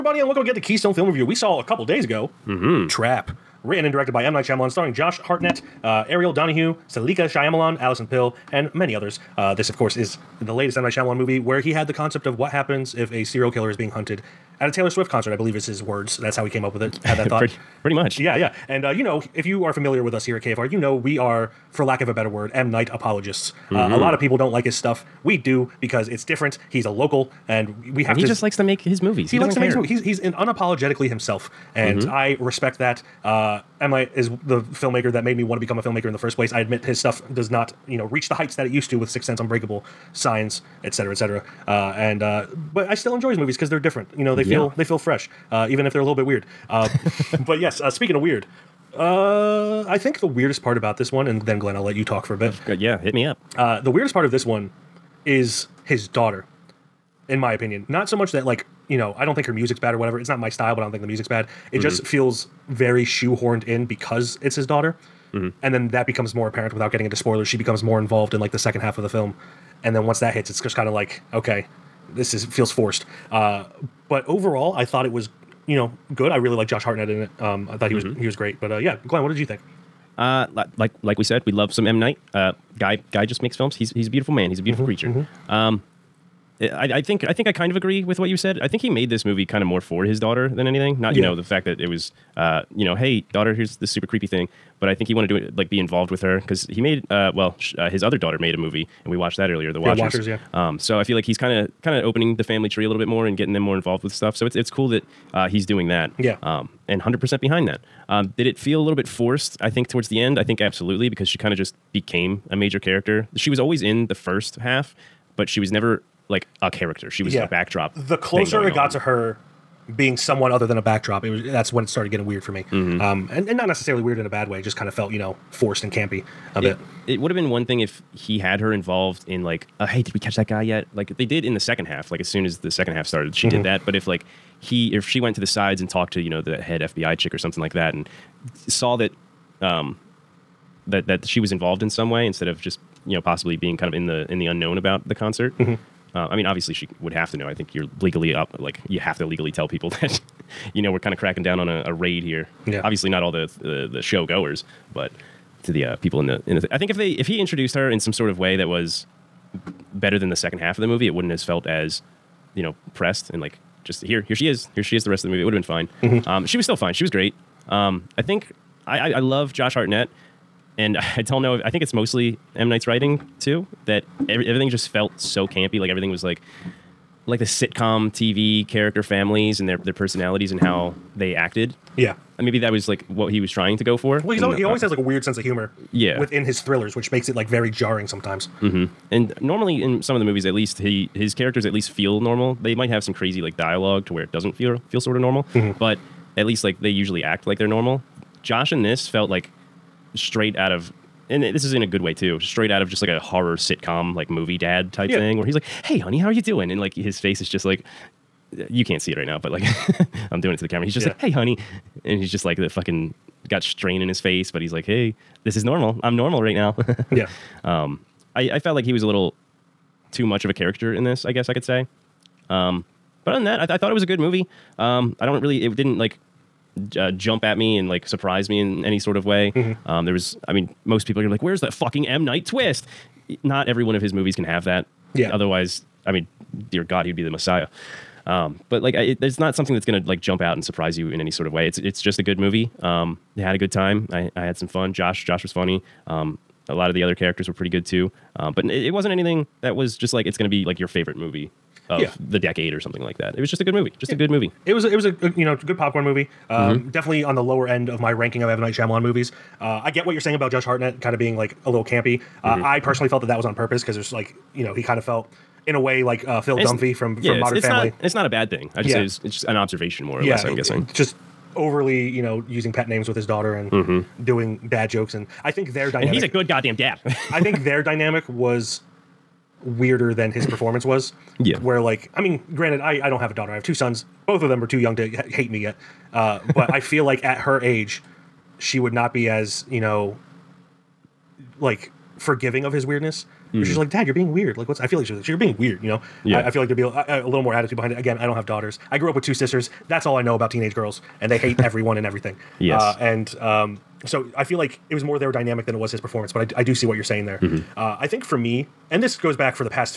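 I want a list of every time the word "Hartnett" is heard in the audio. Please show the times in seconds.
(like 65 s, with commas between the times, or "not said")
5 s, 76 s, 169 s, 260 s.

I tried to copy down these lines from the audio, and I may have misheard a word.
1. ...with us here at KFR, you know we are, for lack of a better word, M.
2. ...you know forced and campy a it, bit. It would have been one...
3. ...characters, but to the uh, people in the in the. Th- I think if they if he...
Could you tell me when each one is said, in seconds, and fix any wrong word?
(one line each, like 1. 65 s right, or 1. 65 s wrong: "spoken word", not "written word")
1. 20 s right
2. 125 s right
3. 154 s wrong: "goers", not "characters".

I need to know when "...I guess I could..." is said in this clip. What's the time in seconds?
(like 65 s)
221 s.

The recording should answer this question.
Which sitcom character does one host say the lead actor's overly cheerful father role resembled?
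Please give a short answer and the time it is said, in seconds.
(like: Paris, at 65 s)
Phil Dunphy, at 266 s.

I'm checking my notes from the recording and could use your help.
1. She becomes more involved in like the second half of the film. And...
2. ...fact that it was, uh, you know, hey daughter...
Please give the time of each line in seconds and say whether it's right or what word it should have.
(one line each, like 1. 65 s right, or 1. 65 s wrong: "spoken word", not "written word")
1. 67 s right
2. 91 s right.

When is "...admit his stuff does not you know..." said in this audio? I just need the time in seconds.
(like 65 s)
36 s.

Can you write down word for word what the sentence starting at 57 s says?
Not so much that like you know, I don't think her music's bad or whatever.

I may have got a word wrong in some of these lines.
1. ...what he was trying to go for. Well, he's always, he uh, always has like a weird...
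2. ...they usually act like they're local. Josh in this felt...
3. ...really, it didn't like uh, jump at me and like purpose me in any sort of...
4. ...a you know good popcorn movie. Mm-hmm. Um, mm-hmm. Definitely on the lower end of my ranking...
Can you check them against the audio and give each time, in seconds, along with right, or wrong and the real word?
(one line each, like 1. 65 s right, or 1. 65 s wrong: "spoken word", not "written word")
1. 183 s right
2. 196 s wrong: "normal", not "local"
3. 225 s wrong: "surprise", not "purpose"
4. 255 s right.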